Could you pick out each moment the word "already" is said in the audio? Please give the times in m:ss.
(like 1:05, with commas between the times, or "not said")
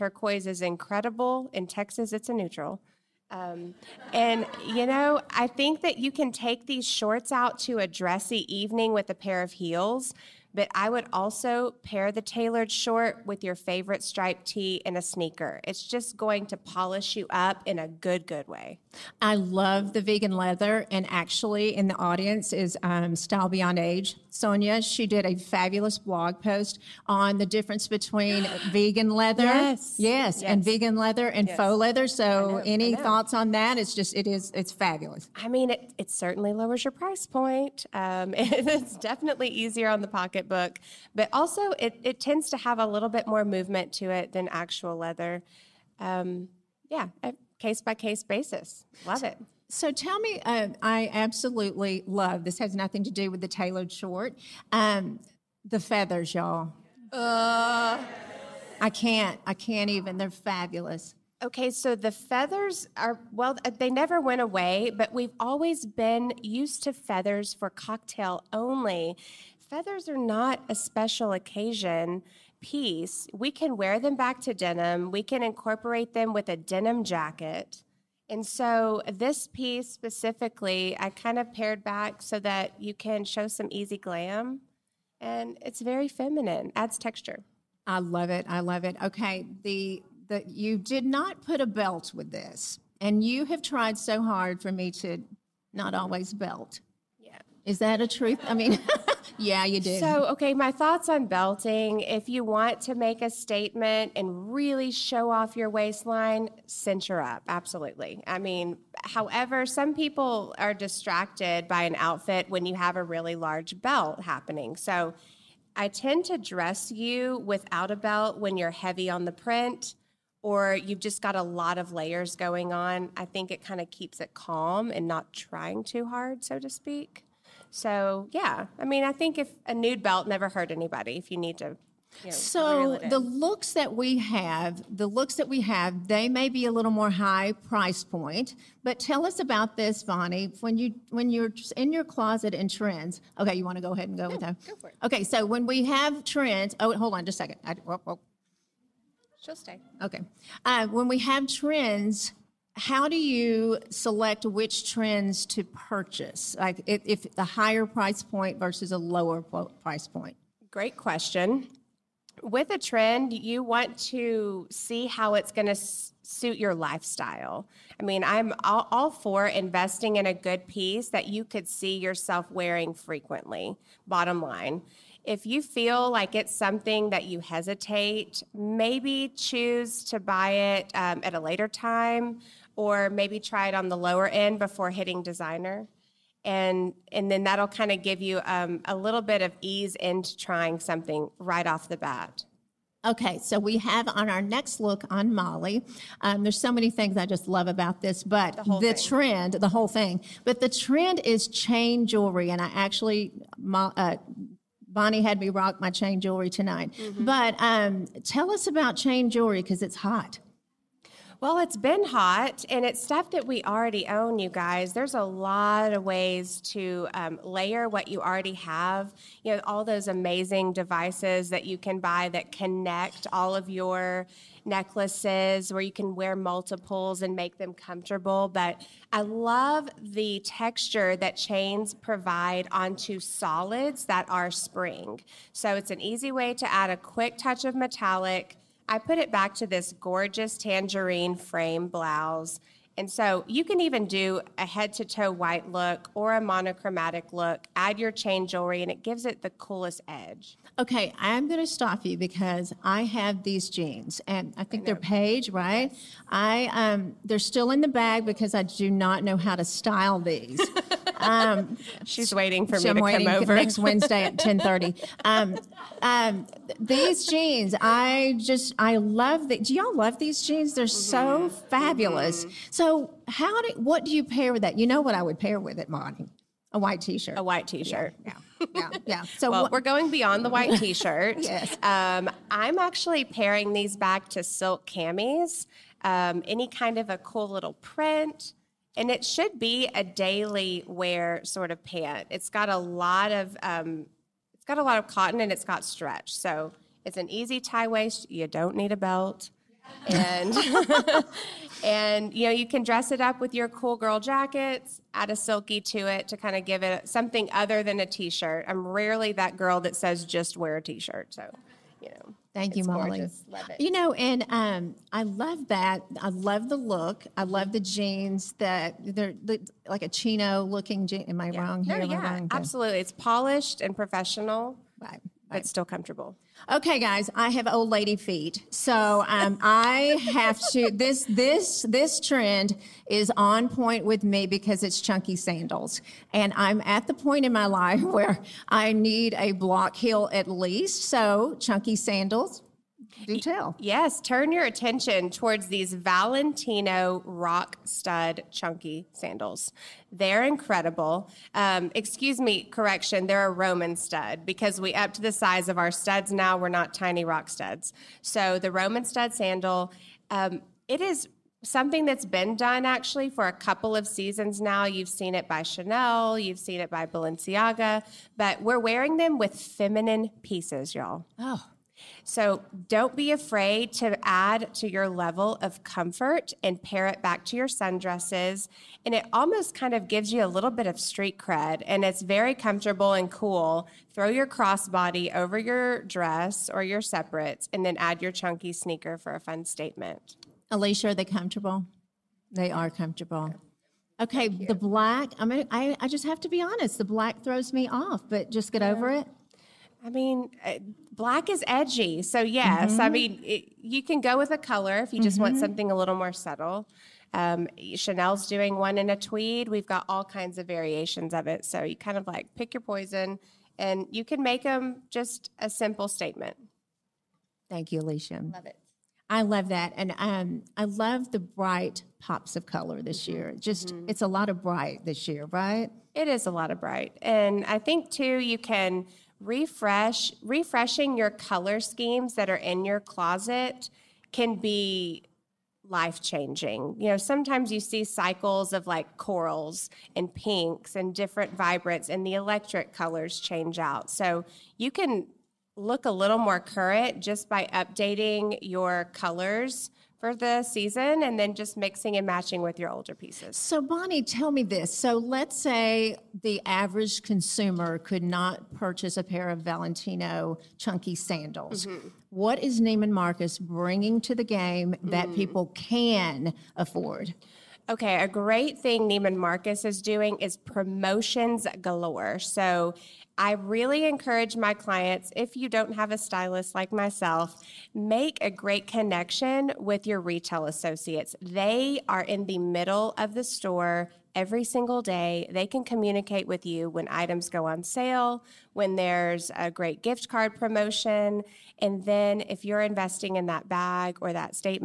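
3:33, 3:38.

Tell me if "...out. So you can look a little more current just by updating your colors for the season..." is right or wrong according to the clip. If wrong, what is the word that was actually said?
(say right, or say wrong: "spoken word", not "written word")
right.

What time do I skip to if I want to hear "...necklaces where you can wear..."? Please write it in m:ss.
3:44.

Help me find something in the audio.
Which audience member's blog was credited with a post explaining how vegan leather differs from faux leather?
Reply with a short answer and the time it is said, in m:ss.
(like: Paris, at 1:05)
Style Beyond Age, at 0:23.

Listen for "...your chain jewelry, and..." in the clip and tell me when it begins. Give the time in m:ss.
4:07.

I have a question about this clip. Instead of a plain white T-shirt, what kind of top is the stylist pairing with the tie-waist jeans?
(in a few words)
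Silk camis.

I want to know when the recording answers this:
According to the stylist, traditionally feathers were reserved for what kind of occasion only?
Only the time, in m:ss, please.
1:07.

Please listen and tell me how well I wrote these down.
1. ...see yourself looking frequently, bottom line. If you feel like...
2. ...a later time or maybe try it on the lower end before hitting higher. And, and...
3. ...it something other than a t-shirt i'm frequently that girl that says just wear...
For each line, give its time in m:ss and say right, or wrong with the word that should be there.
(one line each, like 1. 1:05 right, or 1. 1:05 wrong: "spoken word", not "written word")
1. 2:51 wrong: "wearing", not "looking"
2. 3:01 wrong: "designer", not "higher"
3. 5:06 wrong: "rarely", not "frequently".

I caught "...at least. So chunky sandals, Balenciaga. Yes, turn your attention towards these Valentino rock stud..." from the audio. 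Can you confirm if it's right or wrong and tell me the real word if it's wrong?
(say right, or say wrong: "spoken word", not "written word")
wrong: "Detail", not "Balenciaga".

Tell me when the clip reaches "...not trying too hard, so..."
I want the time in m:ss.
2:05.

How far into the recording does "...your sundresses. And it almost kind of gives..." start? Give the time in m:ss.
6:17.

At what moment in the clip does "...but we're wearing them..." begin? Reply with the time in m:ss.
6:08.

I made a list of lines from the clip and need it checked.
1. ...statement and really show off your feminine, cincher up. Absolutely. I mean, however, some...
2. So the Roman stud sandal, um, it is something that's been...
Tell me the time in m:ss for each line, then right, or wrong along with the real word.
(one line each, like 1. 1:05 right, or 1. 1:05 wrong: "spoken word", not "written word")
1. 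1:43 wrong: "waistline", not "feminine"
2. 5:58 right.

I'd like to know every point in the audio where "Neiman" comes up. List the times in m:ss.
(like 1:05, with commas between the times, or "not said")
7:42, 7:49.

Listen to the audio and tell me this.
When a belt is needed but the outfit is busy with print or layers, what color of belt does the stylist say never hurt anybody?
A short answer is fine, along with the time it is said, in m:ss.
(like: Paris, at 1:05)
Nude, at 2:09.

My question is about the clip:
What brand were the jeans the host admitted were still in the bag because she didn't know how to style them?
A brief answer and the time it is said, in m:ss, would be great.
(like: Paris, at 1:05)
Paige, at 4:14.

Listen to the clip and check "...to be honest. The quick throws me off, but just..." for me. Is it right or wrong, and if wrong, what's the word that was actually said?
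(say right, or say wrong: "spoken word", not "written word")
wrong: "black", not "quick".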